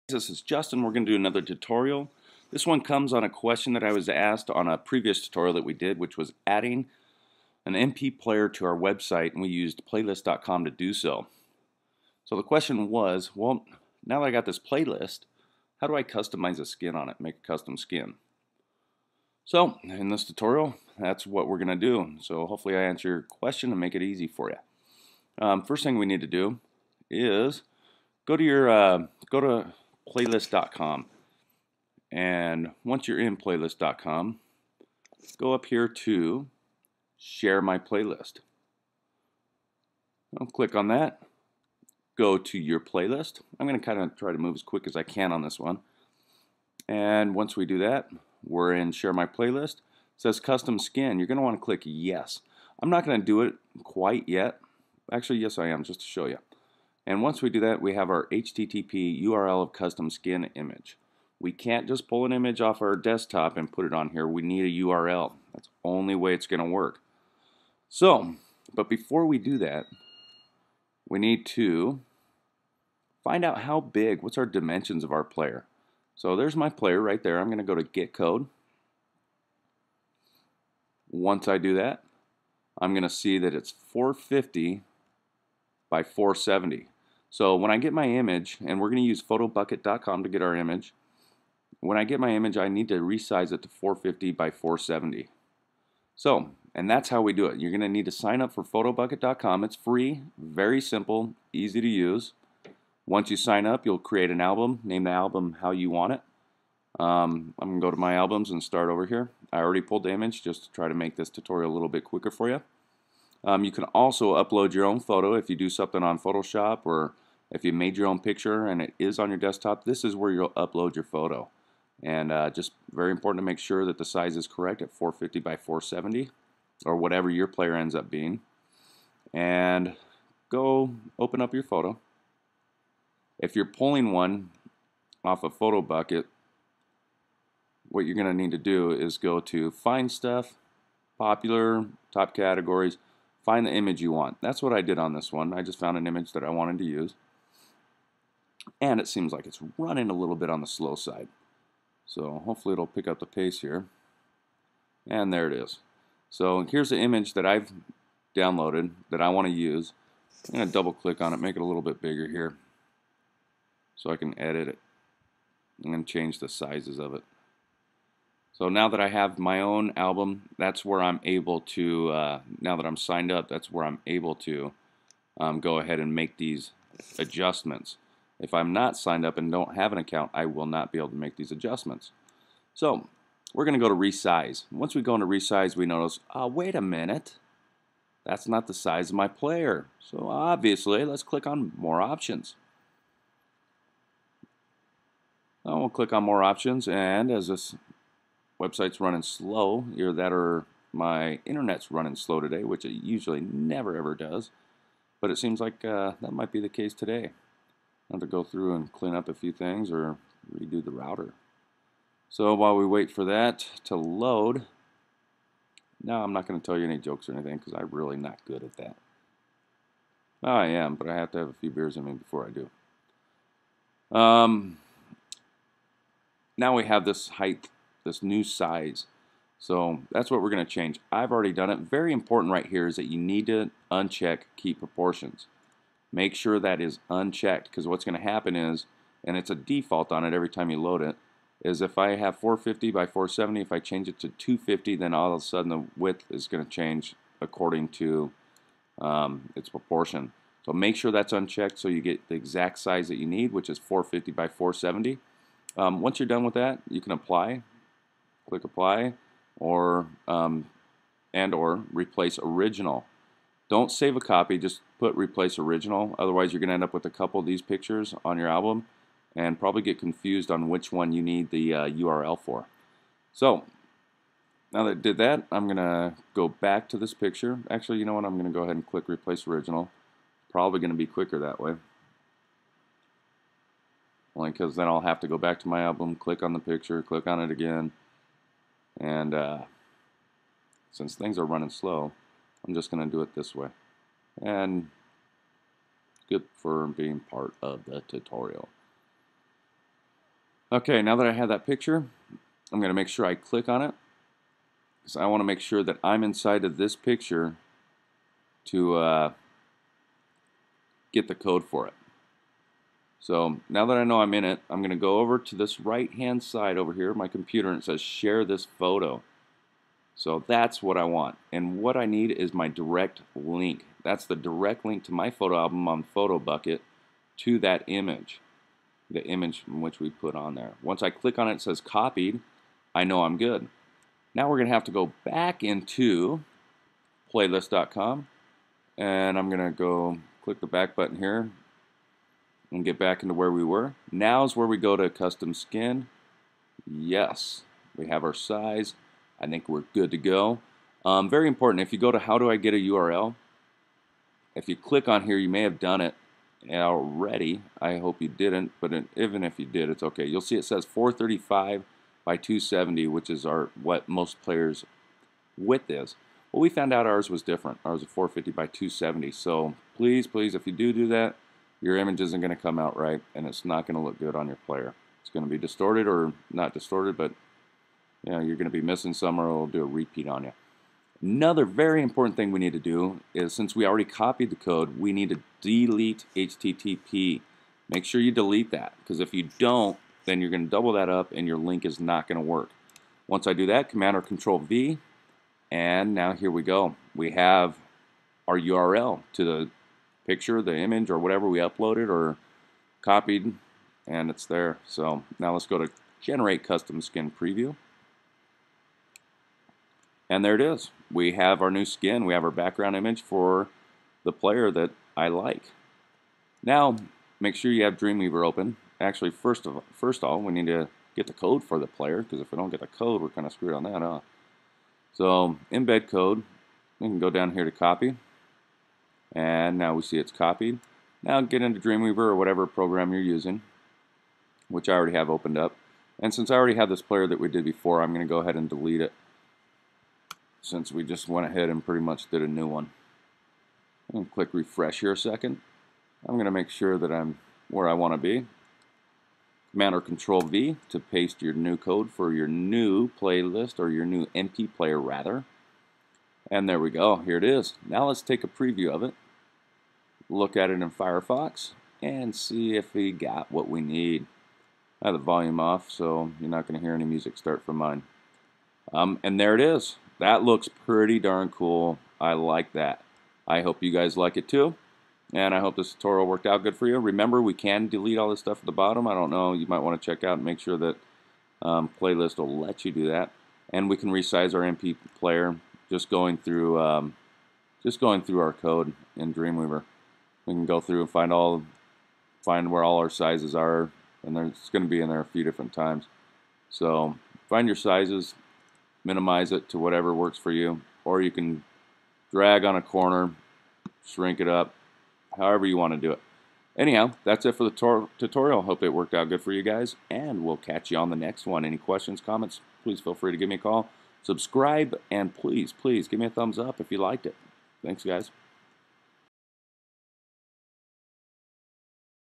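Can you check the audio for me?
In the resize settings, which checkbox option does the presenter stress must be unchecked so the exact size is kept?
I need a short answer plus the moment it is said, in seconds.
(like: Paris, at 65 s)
keep proportions, at 234 s.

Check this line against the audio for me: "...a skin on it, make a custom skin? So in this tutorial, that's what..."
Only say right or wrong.
right.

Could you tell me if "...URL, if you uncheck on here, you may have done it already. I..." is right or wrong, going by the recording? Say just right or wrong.
wrong.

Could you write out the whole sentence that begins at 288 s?
And uh, since things are running slow, I'm just going to do it this way.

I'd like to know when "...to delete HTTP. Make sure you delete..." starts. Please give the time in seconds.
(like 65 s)
385 s.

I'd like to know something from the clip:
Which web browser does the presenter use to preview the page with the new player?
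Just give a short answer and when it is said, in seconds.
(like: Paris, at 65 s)
Firefox, at 460 s.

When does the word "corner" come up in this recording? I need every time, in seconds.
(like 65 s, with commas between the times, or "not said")
502 s.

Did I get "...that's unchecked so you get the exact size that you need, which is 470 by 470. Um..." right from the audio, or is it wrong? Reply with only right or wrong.
wrong.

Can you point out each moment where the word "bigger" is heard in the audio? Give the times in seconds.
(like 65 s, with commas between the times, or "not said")
162 s.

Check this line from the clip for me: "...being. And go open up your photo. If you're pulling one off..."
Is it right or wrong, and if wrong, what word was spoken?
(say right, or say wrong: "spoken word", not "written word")
right.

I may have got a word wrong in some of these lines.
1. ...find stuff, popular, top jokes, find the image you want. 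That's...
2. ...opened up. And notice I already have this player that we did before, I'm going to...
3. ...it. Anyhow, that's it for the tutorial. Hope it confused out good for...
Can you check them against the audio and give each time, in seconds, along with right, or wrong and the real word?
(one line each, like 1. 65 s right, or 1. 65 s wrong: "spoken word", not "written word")
1. 139 s wrong: "categories", not "jokes"
2. 435 s wrong: "since", not "notice"
3. 506 s wrong: "worked", not "confused".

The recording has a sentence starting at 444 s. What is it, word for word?
I'm click refresh here a second.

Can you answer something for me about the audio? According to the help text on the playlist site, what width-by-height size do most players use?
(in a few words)
435 by 270.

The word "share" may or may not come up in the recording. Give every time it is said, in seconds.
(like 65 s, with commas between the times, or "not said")
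37 s, 48 s, 318 s.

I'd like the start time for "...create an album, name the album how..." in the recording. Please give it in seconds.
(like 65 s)
103 s.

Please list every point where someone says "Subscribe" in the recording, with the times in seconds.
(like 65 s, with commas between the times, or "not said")
514 s.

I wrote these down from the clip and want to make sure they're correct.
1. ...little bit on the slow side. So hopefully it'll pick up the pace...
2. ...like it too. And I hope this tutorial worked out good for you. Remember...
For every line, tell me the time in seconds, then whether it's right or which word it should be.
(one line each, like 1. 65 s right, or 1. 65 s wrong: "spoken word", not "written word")
1. 150 s right
2. 474 s right.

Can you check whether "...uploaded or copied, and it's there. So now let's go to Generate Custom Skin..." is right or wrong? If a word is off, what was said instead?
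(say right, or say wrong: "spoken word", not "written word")
right.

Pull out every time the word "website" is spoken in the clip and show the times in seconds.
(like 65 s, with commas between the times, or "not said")
8 s, 198 s.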